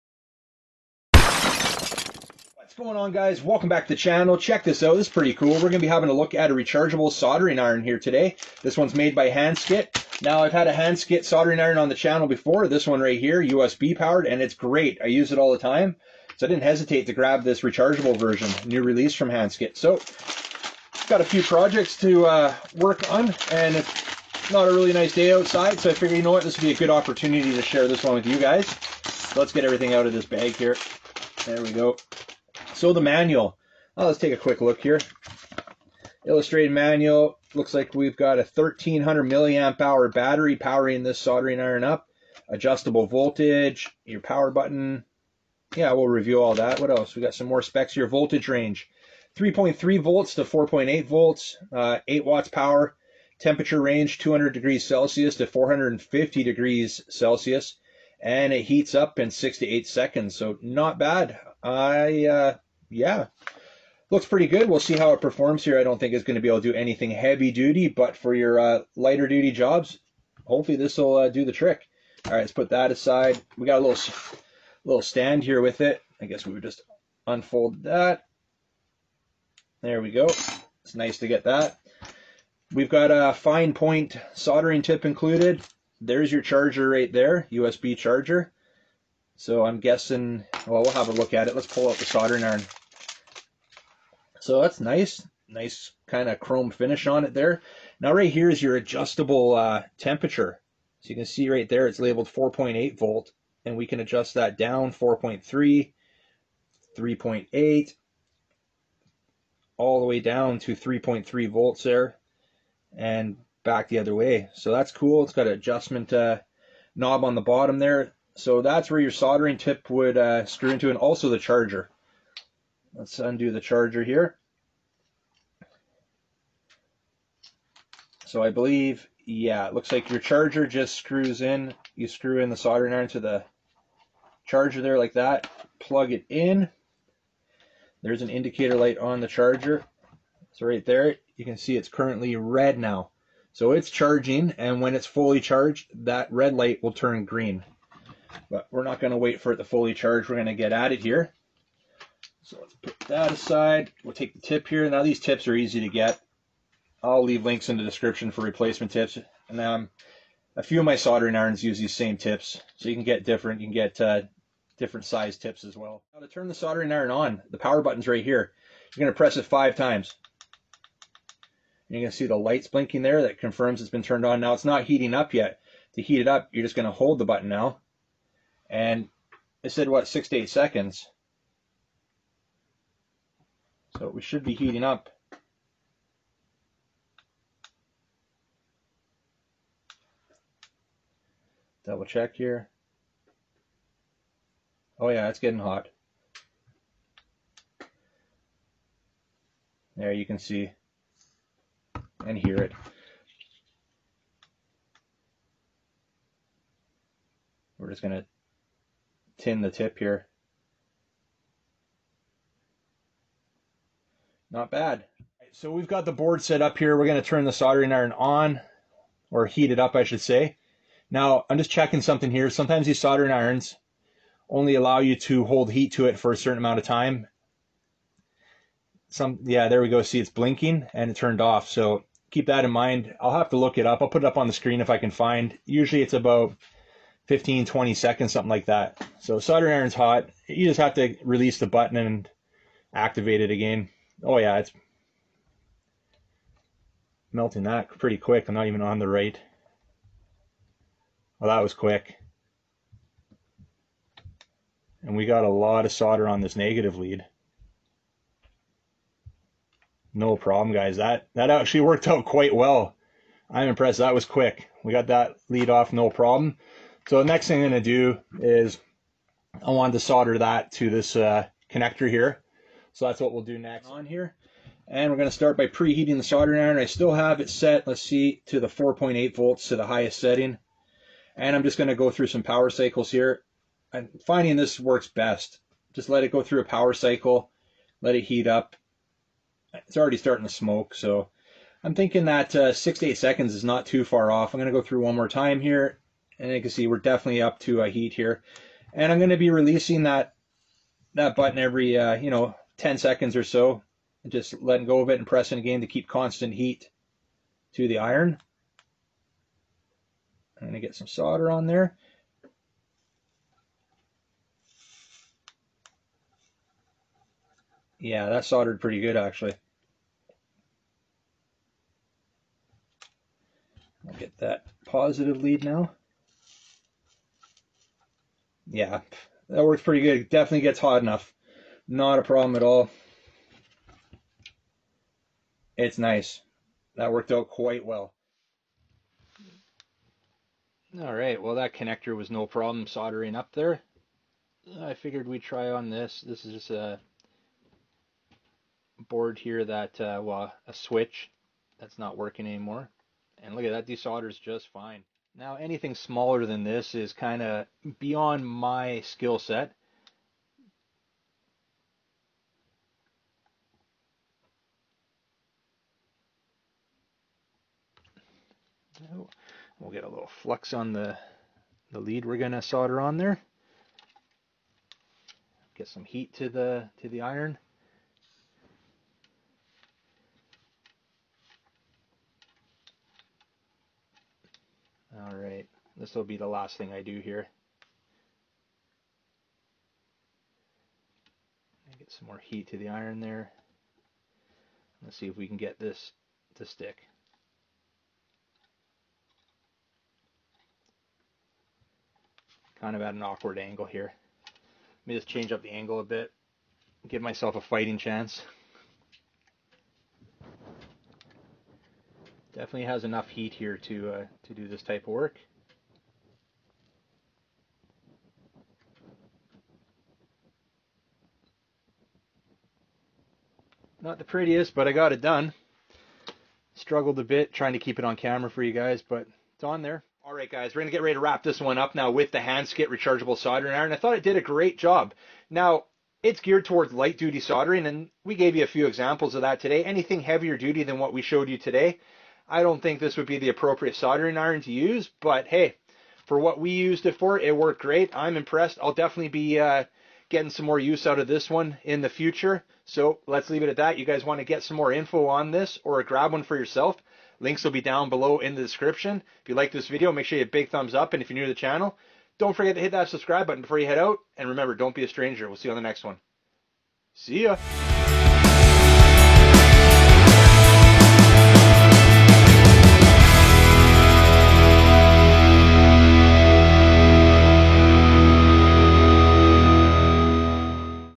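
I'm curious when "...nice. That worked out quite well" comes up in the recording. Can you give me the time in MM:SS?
05:35.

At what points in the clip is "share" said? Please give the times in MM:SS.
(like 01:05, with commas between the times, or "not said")
00:27.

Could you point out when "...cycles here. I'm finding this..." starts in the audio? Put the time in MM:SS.
04:42.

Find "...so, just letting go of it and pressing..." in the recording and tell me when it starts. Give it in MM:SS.
05:03.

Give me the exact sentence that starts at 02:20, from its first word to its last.
So right there, you can see it's currently red now.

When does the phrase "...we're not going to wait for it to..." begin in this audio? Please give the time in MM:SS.
02:28.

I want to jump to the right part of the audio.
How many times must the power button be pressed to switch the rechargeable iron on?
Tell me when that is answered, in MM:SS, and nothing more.
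02:49.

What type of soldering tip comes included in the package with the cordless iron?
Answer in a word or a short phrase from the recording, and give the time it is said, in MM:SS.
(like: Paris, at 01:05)
fine point, at 01:23.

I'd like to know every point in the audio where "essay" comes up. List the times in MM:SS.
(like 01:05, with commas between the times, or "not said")
not said.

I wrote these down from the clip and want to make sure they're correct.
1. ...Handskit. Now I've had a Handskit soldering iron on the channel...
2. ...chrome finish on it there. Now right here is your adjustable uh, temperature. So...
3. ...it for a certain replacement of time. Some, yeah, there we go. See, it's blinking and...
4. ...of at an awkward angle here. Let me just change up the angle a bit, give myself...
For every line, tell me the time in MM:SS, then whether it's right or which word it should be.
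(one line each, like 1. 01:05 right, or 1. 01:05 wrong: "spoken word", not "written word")
1. 00:09 right
2. 01:36 right
3. 03:46 wrong: "amount", not "replacement"
4. 06:42 right.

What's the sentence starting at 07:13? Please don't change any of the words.
I thought it did a great job.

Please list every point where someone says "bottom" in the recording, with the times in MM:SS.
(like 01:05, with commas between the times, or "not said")
01:57.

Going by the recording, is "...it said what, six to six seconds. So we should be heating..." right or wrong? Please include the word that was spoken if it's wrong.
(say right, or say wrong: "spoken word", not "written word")
wrong: "eight", not "six".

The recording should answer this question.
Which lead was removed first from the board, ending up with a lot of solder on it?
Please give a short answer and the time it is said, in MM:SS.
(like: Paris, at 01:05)
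negative lead, at 04:16.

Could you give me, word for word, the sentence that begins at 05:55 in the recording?
Now anything smaller than this is kind of beyond my skill set.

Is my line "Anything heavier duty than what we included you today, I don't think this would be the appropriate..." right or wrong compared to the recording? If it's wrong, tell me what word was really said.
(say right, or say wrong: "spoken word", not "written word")
wrong: "showed", not "included".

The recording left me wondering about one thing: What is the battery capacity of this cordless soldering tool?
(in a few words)
1300 milliamp hour.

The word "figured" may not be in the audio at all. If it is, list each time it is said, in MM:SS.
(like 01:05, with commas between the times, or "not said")
00:25, 05:44.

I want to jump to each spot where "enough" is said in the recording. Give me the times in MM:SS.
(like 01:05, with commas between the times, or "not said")
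05:31, 06:53.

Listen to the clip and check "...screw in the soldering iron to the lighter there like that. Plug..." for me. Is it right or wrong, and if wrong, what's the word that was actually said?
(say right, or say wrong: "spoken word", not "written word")
wrong: "charger", not "lighter".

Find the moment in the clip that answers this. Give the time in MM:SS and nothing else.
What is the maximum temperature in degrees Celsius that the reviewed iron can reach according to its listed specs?
00:55.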